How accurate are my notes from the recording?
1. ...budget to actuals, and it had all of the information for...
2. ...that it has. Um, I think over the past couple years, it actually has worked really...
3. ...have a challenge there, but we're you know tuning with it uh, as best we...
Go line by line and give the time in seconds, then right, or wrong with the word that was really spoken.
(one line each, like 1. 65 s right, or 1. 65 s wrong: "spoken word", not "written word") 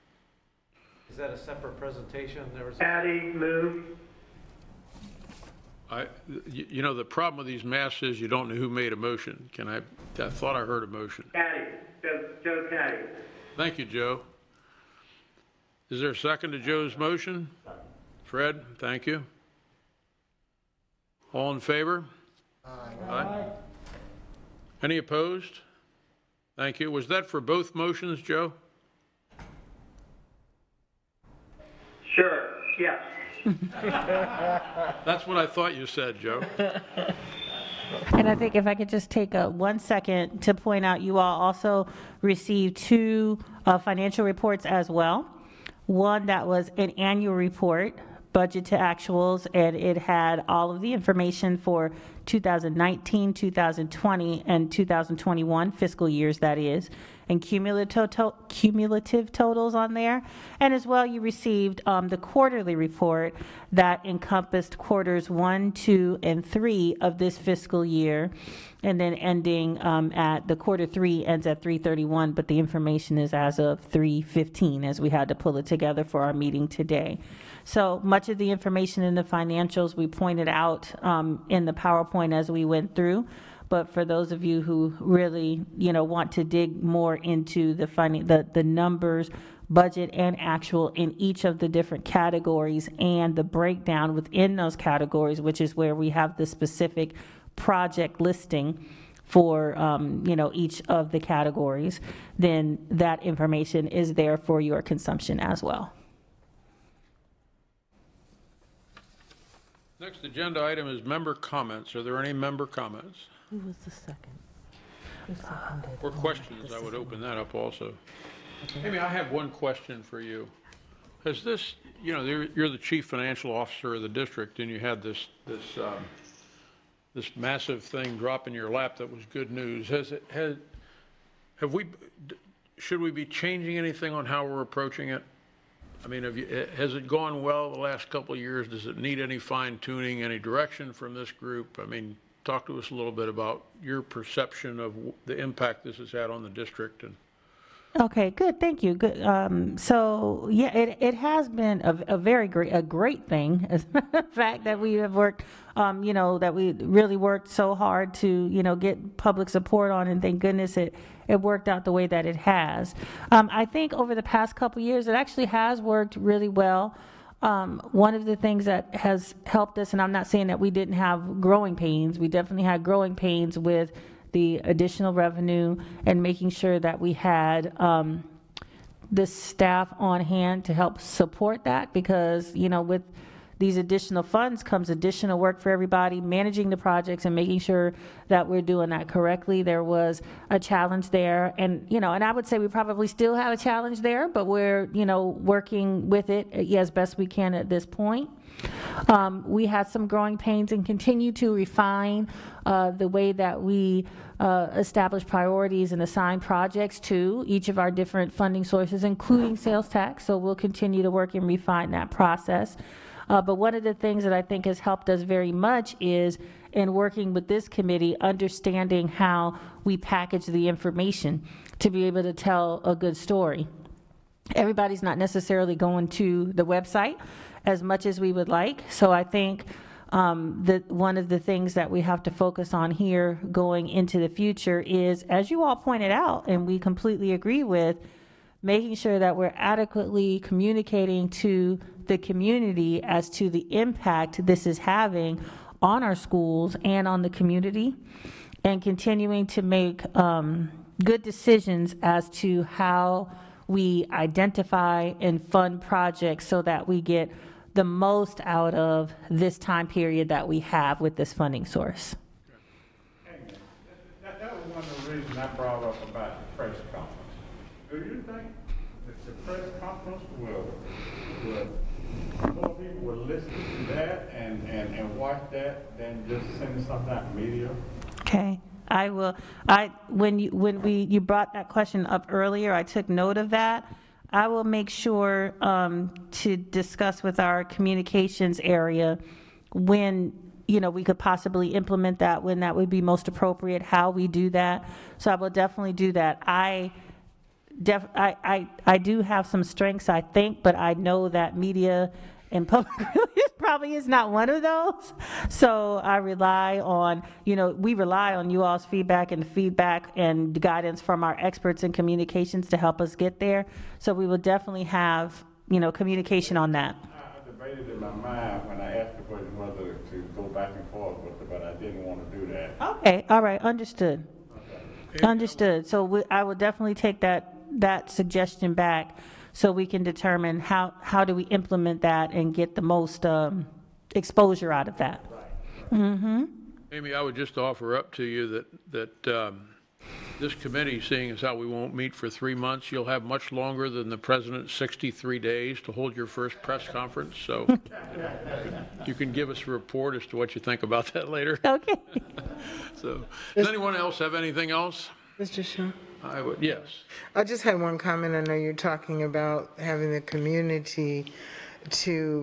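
1. 48 s right
2. 162 s right
3. 193 s wrong: "working", not "tuning".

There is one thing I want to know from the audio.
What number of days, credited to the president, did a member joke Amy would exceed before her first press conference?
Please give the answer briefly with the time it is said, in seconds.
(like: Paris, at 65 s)
63, at 344 s.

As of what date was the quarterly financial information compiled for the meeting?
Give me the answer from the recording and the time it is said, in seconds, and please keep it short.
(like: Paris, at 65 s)
3/15, at 73 s.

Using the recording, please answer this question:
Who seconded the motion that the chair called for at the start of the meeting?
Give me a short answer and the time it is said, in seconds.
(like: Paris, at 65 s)
Fred, at 18 s.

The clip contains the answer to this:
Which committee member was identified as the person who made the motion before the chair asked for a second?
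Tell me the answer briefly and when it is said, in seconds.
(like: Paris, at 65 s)
Joe Catti, at 12 s.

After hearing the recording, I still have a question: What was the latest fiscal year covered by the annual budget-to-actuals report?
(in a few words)
2021.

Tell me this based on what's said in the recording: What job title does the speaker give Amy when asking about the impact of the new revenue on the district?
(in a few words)
chief financial officer.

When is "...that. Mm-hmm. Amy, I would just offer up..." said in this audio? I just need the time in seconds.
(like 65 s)
334 s.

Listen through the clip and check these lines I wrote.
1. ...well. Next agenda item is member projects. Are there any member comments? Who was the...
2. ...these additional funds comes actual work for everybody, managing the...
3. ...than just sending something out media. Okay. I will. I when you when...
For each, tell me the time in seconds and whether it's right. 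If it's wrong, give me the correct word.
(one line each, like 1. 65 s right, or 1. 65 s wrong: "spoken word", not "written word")
1. 105 s wrong: "comments", not "projects"
2. 183 s wrong: "additional", not "actual"
3. 275 s right.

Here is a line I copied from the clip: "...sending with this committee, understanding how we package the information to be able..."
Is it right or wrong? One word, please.
wrong.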